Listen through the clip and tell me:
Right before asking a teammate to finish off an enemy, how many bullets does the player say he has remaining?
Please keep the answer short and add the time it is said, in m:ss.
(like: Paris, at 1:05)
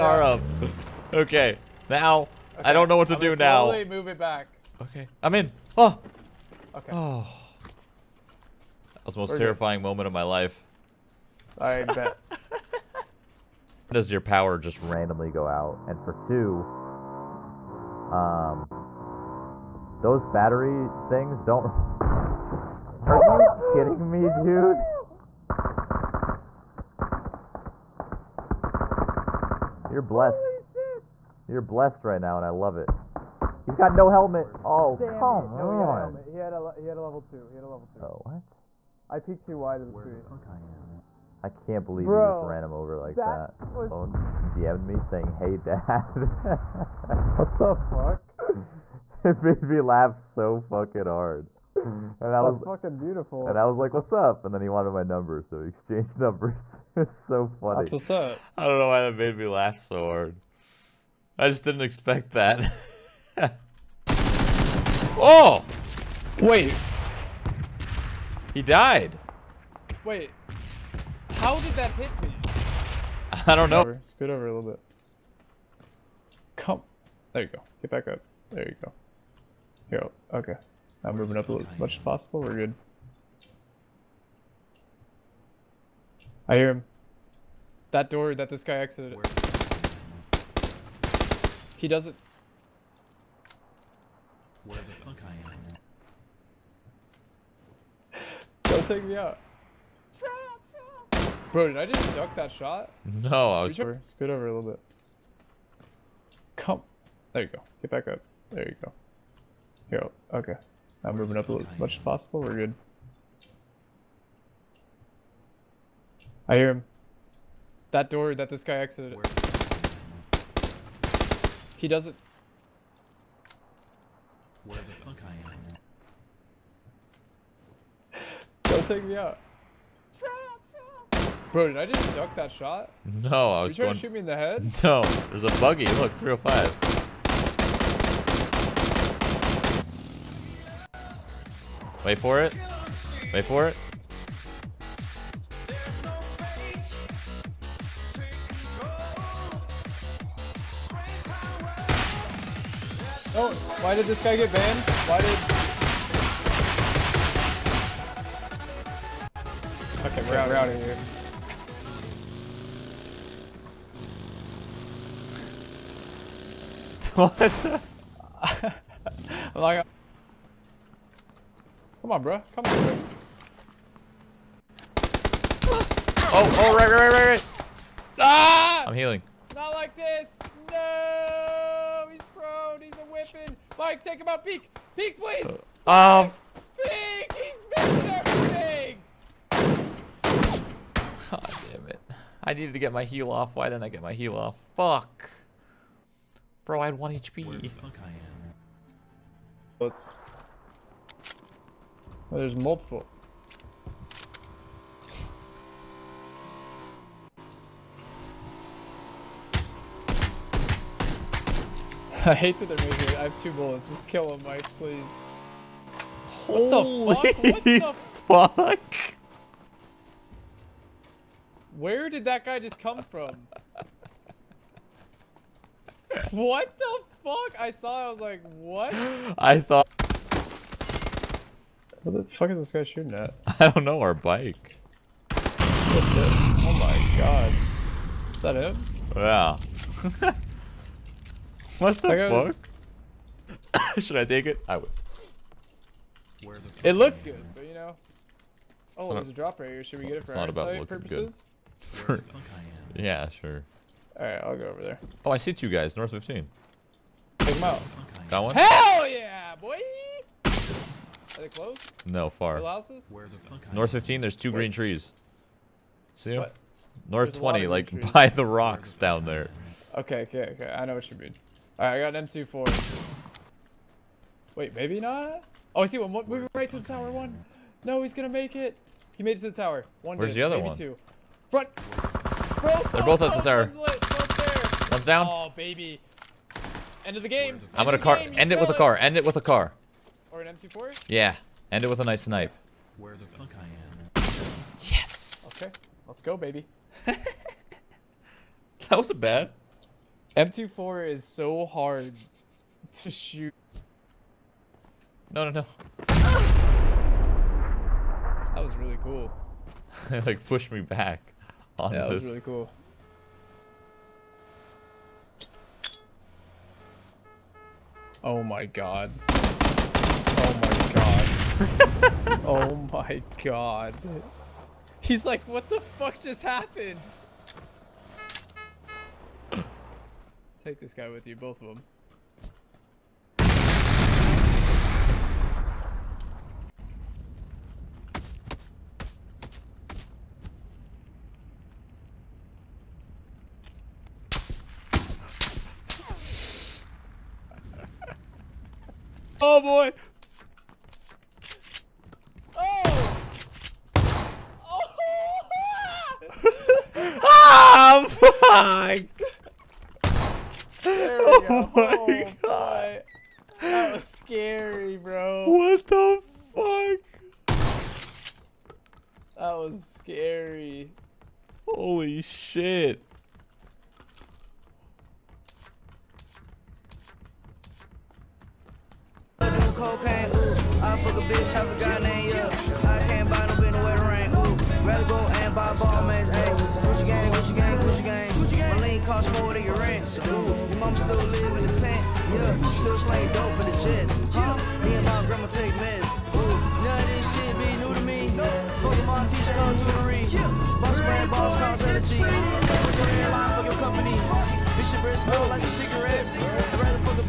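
2, at 3:33.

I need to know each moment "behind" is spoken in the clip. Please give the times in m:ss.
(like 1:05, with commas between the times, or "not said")
not said.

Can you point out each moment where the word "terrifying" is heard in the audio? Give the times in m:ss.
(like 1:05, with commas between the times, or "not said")
0:09.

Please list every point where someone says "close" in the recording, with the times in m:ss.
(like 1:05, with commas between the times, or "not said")
4:21.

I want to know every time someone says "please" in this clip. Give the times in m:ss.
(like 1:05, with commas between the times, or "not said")
3:05, 3:34.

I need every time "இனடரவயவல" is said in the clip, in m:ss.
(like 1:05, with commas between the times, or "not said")
not said.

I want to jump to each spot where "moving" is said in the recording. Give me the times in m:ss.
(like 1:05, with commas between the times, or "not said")
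1:21, 1:51, 4:36.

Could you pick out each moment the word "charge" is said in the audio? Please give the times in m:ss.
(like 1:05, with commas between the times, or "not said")
not said.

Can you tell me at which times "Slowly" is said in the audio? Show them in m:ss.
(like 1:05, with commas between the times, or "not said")
0:03.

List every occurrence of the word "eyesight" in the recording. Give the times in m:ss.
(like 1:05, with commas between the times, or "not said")
4:10.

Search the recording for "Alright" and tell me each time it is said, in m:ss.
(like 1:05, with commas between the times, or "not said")
4:14, 4:31.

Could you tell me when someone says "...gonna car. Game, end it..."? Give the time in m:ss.
4:47.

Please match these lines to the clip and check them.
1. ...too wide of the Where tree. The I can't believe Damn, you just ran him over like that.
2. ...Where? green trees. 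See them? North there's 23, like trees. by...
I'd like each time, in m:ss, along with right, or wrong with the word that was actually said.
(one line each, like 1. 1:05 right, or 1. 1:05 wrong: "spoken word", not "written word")
1. 0:39 wrong: "Bro", not "Damn"
2. 4:24 wrong: "20", not "23".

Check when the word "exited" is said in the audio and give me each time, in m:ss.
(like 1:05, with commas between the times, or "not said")
1:28, 1:58.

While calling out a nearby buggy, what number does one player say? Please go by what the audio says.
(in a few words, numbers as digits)
305.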